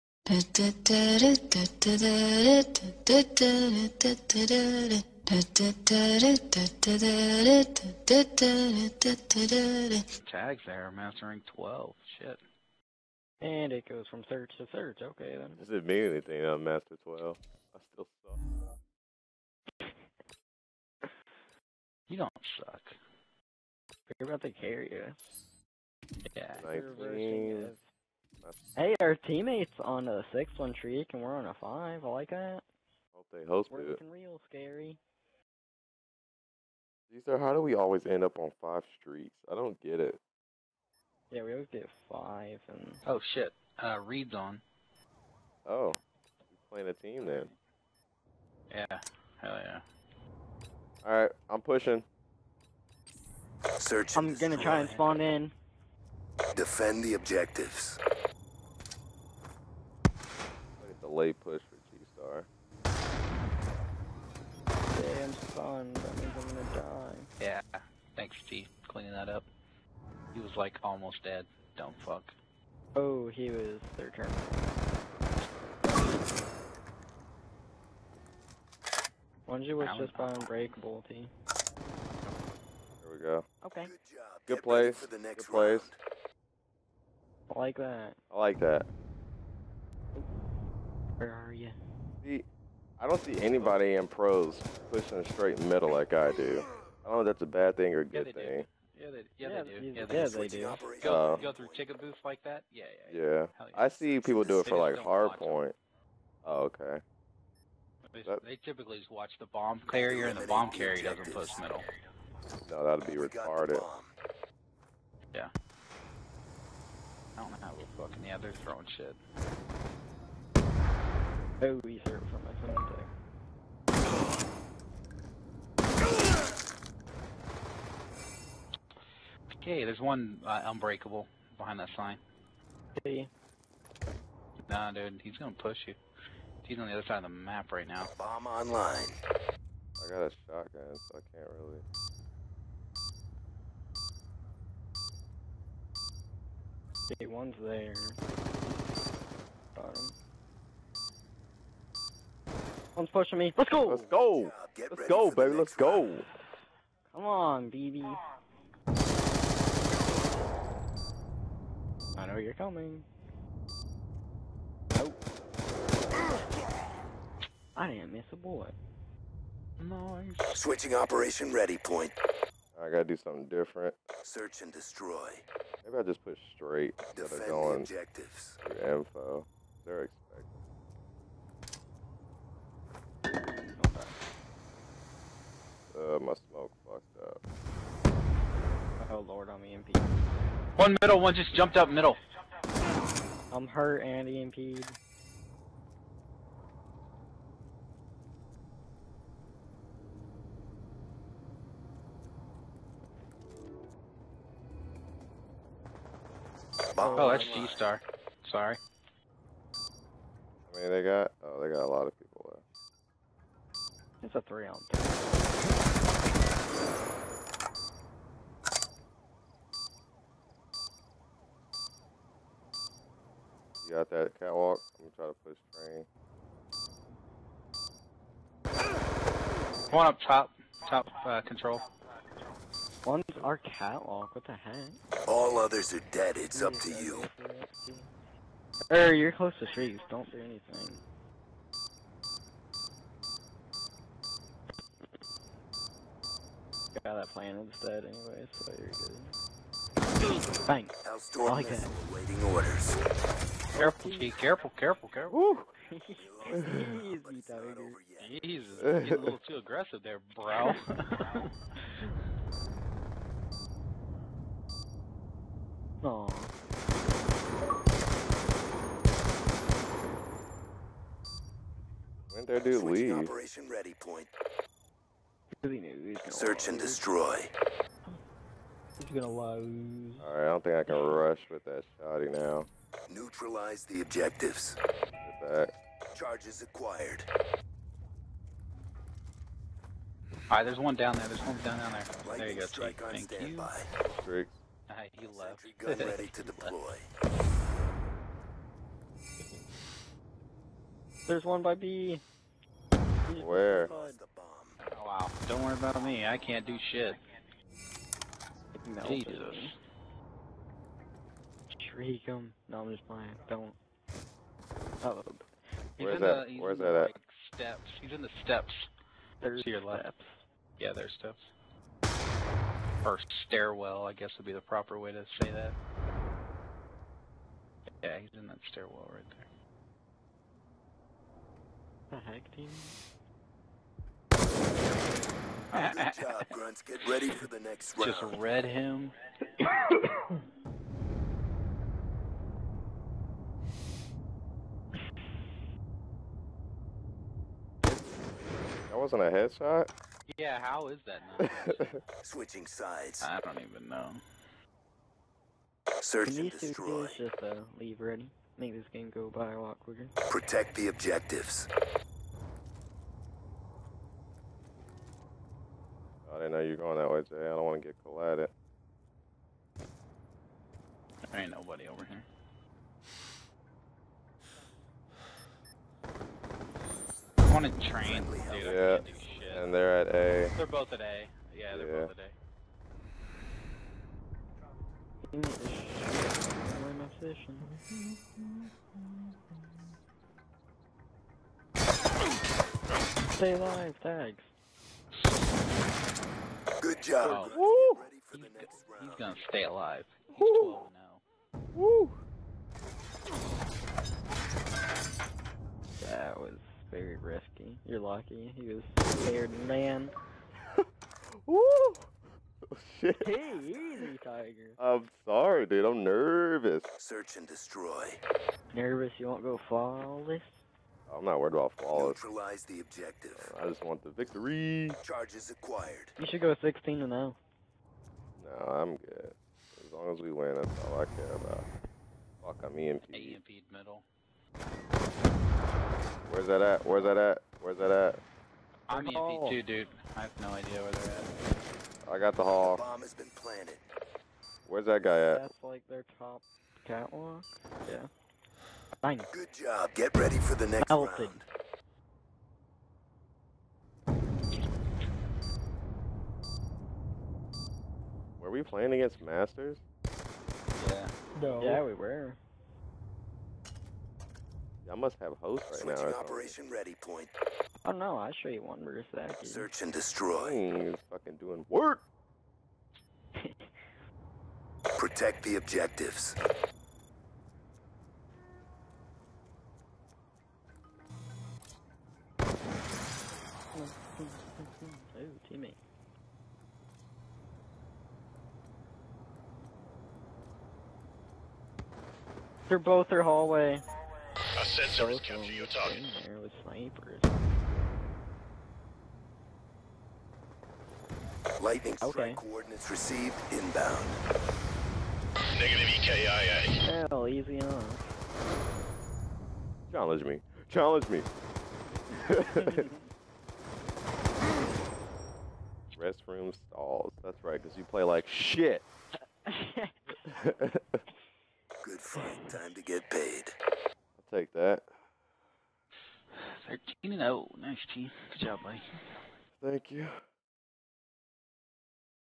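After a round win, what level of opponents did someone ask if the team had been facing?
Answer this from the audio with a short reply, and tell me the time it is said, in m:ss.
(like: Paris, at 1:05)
Masters, at 7:39.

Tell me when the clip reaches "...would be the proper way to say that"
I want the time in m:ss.
5:24.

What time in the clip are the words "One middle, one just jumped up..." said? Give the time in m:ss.
3:10.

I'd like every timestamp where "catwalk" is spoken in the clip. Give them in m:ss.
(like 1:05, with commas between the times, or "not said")
3:44, 3:53, 7:26.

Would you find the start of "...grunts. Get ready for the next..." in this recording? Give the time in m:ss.
5:36.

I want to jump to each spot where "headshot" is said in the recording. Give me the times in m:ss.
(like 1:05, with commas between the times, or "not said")
5:49.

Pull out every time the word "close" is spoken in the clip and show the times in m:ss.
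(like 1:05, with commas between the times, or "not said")
3:59.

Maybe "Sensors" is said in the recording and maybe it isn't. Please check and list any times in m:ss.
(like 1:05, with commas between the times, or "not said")
8:14.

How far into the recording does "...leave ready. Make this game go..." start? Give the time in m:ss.
5:57.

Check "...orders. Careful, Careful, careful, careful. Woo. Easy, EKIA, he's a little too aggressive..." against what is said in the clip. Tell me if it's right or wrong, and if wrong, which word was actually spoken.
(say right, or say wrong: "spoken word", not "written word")
wrong: "Jesus", not "EKIA".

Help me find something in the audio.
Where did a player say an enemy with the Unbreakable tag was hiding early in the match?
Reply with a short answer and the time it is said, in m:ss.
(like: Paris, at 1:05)
behind that sign, at 2:11.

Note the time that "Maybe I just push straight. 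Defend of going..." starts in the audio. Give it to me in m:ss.
2:55.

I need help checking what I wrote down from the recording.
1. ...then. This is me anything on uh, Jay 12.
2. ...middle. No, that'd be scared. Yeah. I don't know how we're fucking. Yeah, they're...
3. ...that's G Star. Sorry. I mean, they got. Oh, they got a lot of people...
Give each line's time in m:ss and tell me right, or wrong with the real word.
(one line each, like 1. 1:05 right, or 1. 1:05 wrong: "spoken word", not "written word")
1. 0:15 wrong: "Master", not "Jay"
2. 1:51 wrong: "retarded", not "scared"
3. 3:27 right.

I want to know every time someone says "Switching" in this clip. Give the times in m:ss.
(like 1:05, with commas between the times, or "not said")
2:50, 5:52, 7:45.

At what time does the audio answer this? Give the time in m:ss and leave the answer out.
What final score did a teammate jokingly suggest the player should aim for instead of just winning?
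7:06.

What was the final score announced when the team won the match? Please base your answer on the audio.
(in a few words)
13 and 0.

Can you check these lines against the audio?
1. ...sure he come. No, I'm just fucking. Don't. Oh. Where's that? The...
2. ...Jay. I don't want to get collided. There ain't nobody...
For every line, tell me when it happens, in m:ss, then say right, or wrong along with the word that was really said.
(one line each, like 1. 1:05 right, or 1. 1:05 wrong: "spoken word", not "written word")
1. 5:11 wrong: "playing", not "fucking"
2. 6:07 right.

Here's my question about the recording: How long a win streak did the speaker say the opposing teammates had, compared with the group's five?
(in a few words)
61.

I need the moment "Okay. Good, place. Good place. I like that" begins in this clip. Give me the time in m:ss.
1:23.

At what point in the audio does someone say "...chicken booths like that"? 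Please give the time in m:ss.
1:41.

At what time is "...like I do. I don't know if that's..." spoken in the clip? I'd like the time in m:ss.
1:35.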